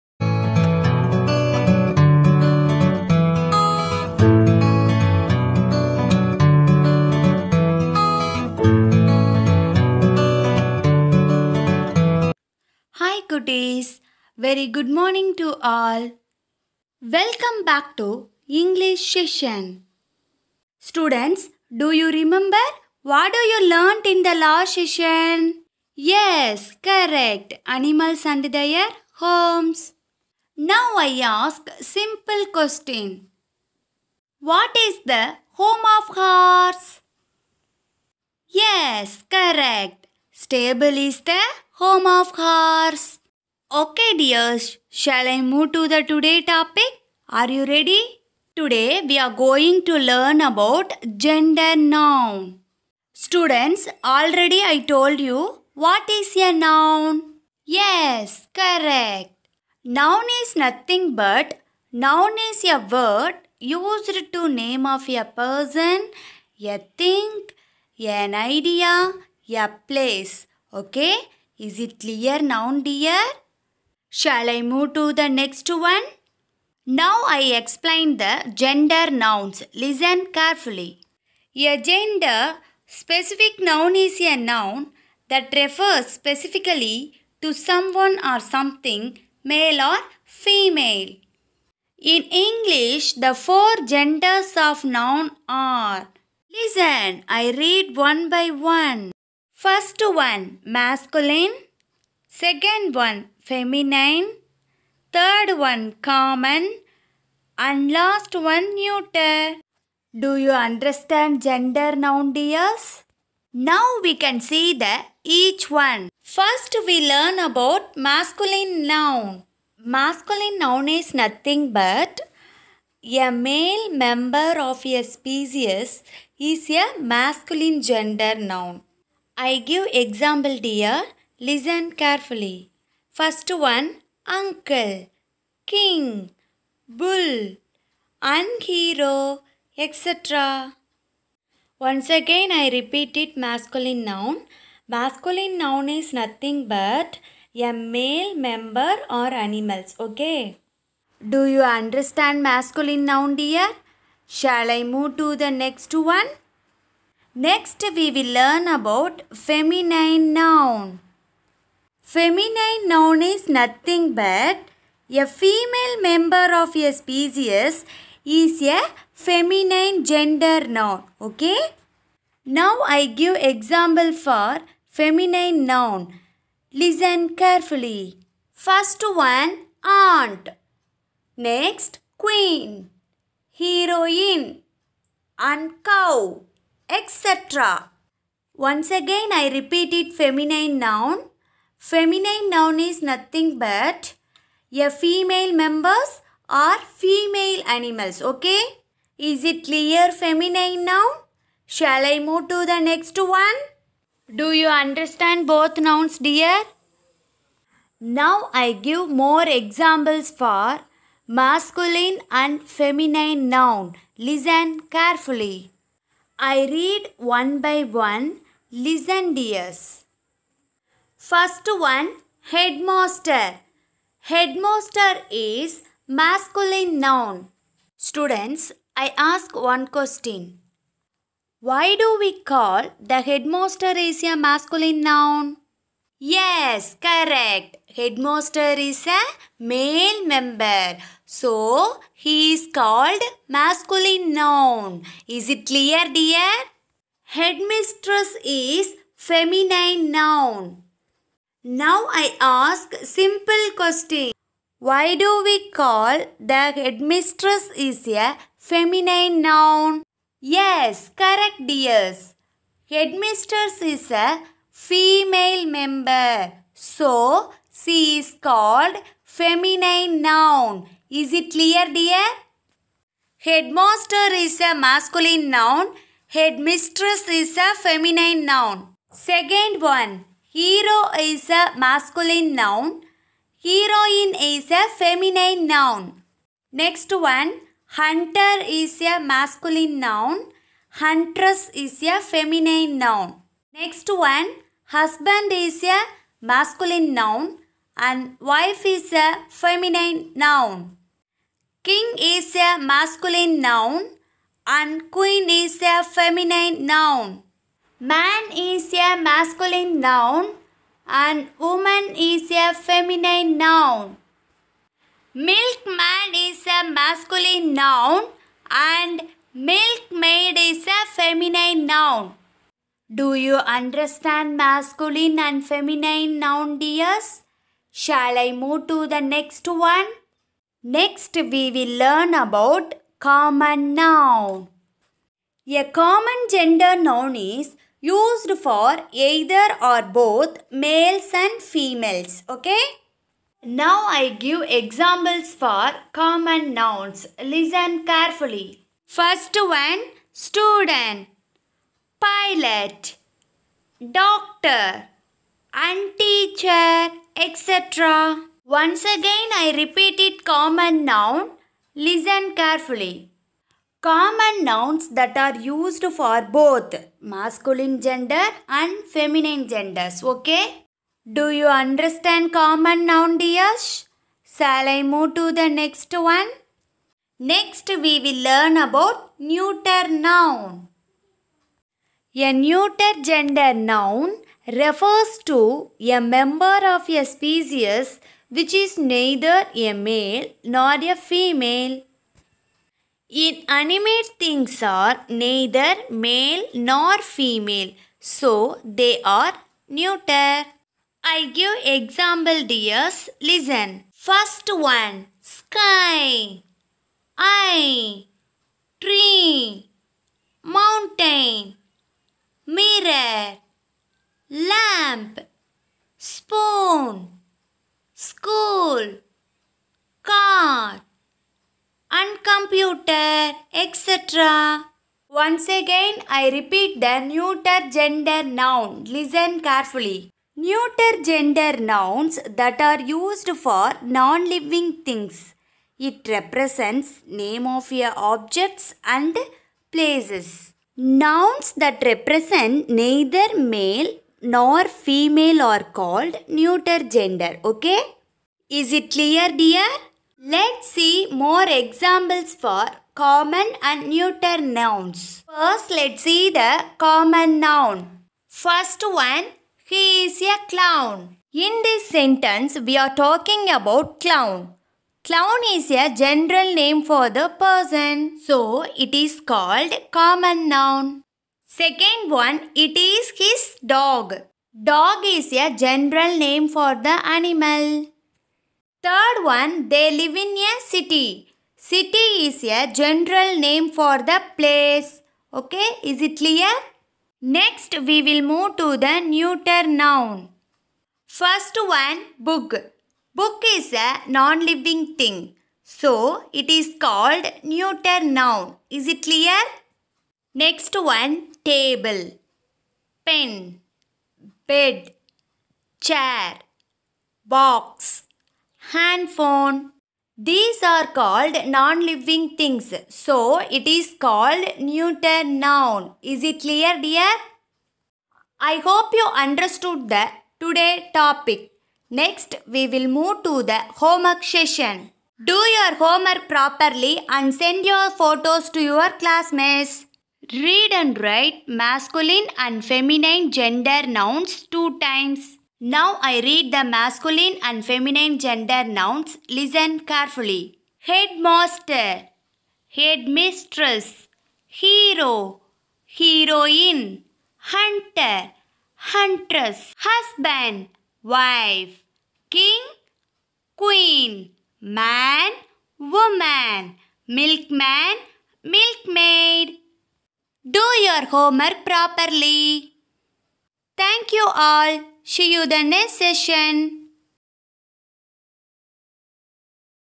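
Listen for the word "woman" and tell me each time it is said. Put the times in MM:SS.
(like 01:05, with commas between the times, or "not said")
05:11, 09:15.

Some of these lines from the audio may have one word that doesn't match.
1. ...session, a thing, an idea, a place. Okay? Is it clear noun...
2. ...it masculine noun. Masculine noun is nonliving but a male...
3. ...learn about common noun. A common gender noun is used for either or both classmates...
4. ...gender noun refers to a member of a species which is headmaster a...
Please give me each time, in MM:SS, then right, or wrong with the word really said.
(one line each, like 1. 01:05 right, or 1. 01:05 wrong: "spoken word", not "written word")
1. 01:05 wrong: "person", not "session"
2. 02:23 wrong: "nothing", not "nonliving"
3. 05:31 wrong: "males", not "classmates"
4. 06:23 wrong: "neither", not "headmaster".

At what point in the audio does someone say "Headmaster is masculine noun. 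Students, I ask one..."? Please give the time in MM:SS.
03:44.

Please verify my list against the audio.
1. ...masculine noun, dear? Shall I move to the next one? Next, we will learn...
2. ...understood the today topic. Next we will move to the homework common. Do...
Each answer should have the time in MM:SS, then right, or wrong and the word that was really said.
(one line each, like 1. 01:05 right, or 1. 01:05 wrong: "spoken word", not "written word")
1. 02:32 right
2. 08:39 wrong: "session", not "common".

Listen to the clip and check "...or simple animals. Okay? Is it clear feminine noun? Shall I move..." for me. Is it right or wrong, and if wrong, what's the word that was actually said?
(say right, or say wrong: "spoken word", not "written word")
wrong: "female", not "simple".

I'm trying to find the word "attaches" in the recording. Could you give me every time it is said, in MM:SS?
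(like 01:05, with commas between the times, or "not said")
not said.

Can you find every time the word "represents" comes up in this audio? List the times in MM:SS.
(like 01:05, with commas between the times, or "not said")
07:16, 07:22.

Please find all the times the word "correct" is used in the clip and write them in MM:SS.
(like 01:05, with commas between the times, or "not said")
00:26, 00:39, 00:58, 03:56, 04:21.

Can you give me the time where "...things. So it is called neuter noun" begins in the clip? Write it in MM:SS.
08:32.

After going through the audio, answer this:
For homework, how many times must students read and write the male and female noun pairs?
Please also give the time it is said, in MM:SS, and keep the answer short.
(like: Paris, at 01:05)
2, at 08:54.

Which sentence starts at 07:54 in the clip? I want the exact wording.
Dog is a general name for the animal.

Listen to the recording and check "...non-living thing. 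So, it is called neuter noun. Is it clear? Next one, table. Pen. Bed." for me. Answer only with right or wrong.
right.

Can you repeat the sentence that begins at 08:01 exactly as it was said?
City is a general name for the place.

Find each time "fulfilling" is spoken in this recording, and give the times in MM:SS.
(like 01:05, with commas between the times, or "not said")
not said.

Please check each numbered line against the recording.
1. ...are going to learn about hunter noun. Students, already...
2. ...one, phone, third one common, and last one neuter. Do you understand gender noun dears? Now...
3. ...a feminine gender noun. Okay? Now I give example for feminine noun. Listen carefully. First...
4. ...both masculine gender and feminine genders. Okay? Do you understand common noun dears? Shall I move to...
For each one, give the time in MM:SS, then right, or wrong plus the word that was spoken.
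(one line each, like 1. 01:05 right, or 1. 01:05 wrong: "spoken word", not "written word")
1. 00:49 wrong: "gender", not "hunter"
2. 01:42 wrong: "feminine", not "phone"
3. 02:48 right
4. 06:06 right.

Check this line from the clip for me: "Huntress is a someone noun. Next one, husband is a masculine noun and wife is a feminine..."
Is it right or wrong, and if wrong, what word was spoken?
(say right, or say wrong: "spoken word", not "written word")
wrong: "feminine", not "someone".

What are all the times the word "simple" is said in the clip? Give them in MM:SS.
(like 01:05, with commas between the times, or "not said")
00:31, 04:13.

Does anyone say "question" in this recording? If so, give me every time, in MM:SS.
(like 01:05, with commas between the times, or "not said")
00:32, 03:49, 04:13.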